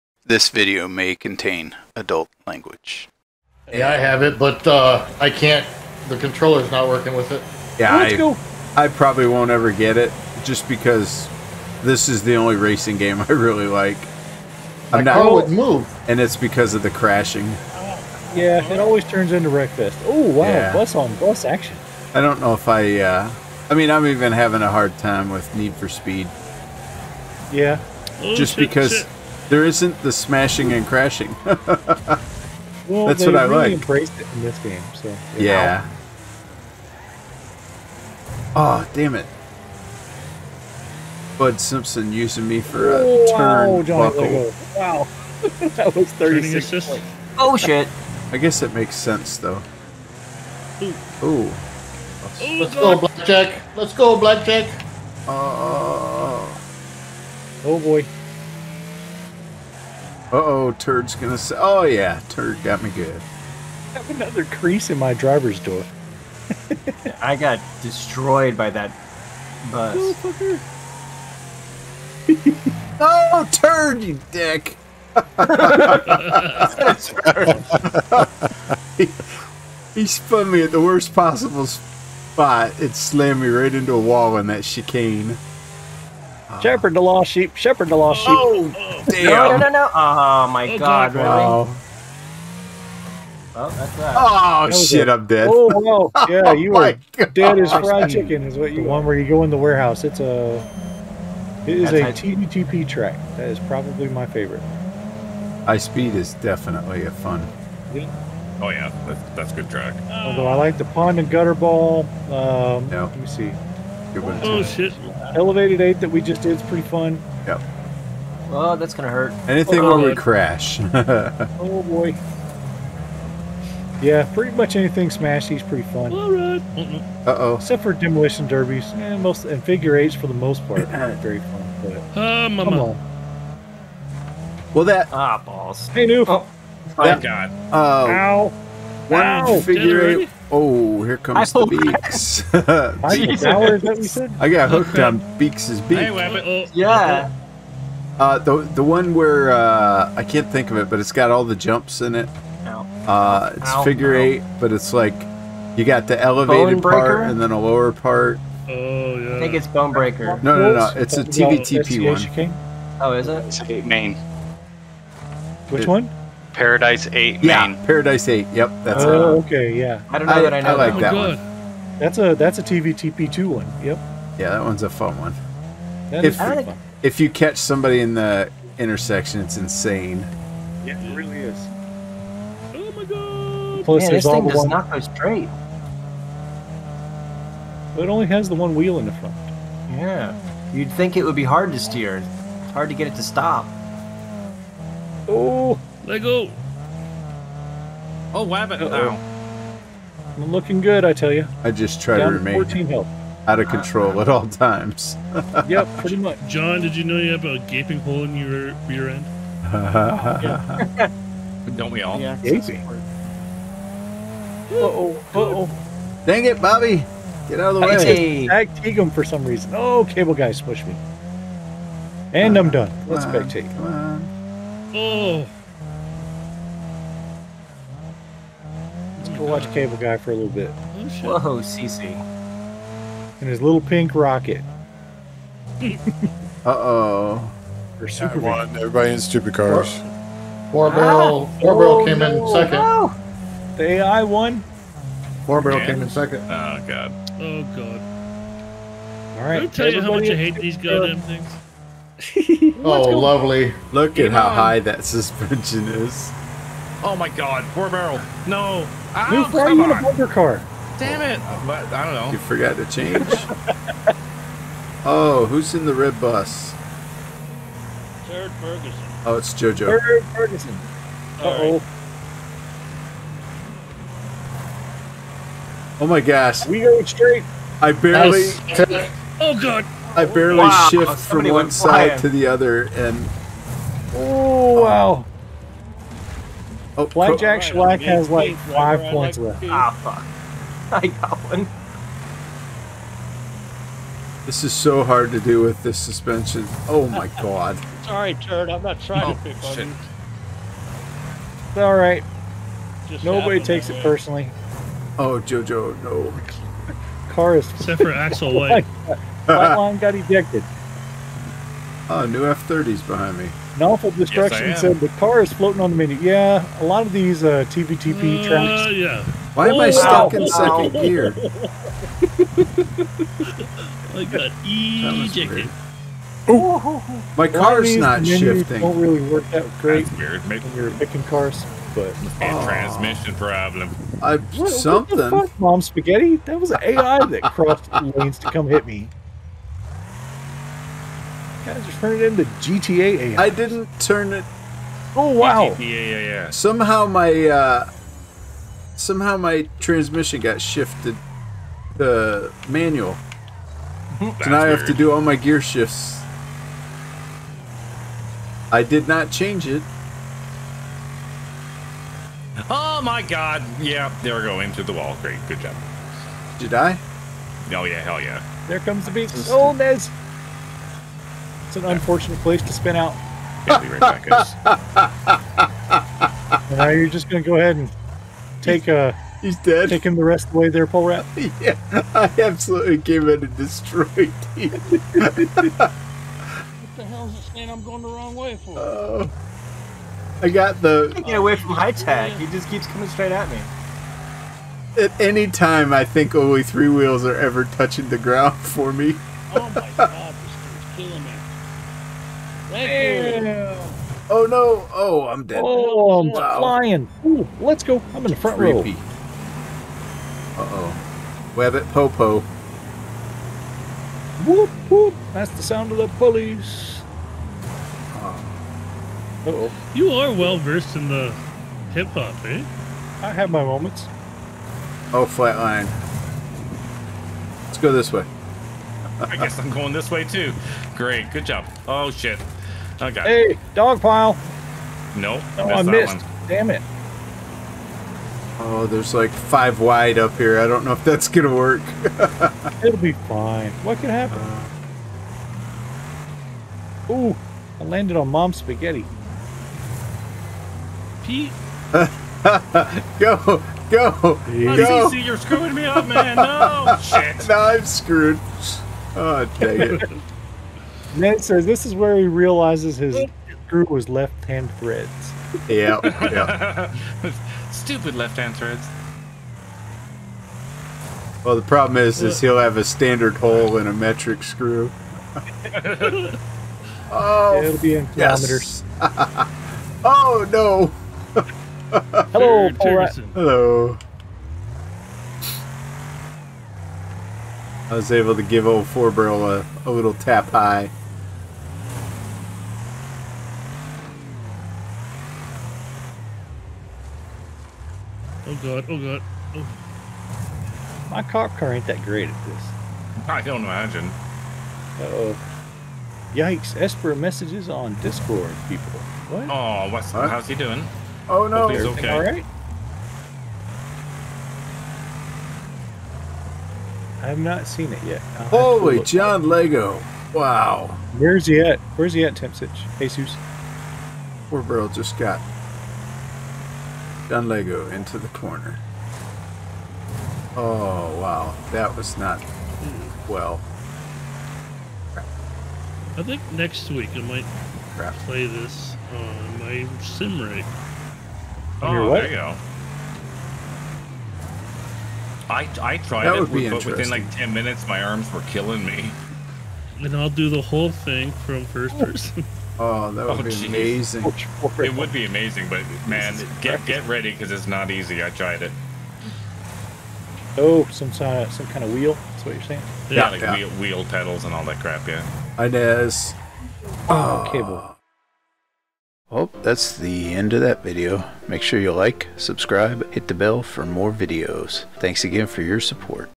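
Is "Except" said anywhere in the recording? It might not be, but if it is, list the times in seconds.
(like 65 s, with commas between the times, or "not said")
127 s, 307 s.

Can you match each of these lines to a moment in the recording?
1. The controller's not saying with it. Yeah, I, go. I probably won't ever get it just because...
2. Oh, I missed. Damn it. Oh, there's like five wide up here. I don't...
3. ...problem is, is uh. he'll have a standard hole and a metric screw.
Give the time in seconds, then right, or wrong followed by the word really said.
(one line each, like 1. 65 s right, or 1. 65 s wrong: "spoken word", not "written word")
1. 6 s wrong: "working", not "saying"
2. 435 s right
3. 471 s right.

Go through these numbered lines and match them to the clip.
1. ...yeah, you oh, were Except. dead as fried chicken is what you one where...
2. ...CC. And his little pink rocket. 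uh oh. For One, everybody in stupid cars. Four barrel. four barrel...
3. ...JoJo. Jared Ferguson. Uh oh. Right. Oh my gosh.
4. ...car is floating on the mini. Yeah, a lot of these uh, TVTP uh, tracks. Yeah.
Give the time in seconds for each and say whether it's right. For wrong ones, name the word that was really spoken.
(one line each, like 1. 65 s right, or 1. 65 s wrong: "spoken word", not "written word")
1. 96 s wrong: "God", not "Except"
2. 231 s right
3. 269 s right
4. 315 s right.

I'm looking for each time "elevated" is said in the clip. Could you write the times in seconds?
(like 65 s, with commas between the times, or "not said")
115 s, 156 s.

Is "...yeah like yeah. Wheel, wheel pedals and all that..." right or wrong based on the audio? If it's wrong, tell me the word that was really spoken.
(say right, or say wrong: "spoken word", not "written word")
right.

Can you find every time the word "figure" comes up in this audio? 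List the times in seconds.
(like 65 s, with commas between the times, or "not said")
129 s, 139 s, 153 s.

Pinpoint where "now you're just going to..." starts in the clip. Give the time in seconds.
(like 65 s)
376 s.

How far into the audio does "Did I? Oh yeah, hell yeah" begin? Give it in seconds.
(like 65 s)
366 s.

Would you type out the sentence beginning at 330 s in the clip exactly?
Maybe when you're picking cars, but and oh.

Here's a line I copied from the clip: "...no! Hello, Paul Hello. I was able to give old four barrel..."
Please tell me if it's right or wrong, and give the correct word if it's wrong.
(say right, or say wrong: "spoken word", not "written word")
right.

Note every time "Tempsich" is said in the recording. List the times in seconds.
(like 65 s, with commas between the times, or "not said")
522 s.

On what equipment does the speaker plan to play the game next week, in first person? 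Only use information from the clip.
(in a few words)
sim rig.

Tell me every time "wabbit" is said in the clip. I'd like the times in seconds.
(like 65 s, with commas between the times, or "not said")
198 s.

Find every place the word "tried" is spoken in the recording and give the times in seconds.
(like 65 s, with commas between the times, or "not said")
545 s, 558 s.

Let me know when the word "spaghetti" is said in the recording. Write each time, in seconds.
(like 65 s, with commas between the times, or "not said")
335 s, 448 s.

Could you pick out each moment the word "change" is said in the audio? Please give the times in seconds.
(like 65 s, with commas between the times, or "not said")
262 s, 359 s.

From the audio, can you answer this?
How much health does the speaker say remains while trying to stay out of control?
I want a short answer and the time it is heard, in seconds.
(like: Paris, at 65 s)
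14, at 202 s.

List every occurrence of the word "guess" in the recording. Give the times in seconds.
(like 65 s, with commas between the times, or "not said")
48 s, 429 s.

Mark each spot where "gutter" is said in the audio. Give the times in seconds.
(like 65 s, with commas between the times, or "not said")
111 s.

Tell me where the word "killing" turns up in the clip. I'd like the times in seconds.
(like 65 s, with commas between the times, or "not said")
401 s, 548 s.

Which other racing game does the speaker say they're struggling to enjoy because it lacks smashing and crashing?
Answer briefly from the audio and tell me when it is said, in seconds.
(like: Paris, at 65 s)
Need for Speed, at 25 s.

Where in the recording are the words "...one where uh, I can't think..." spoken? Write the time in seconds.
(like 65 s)
148 s.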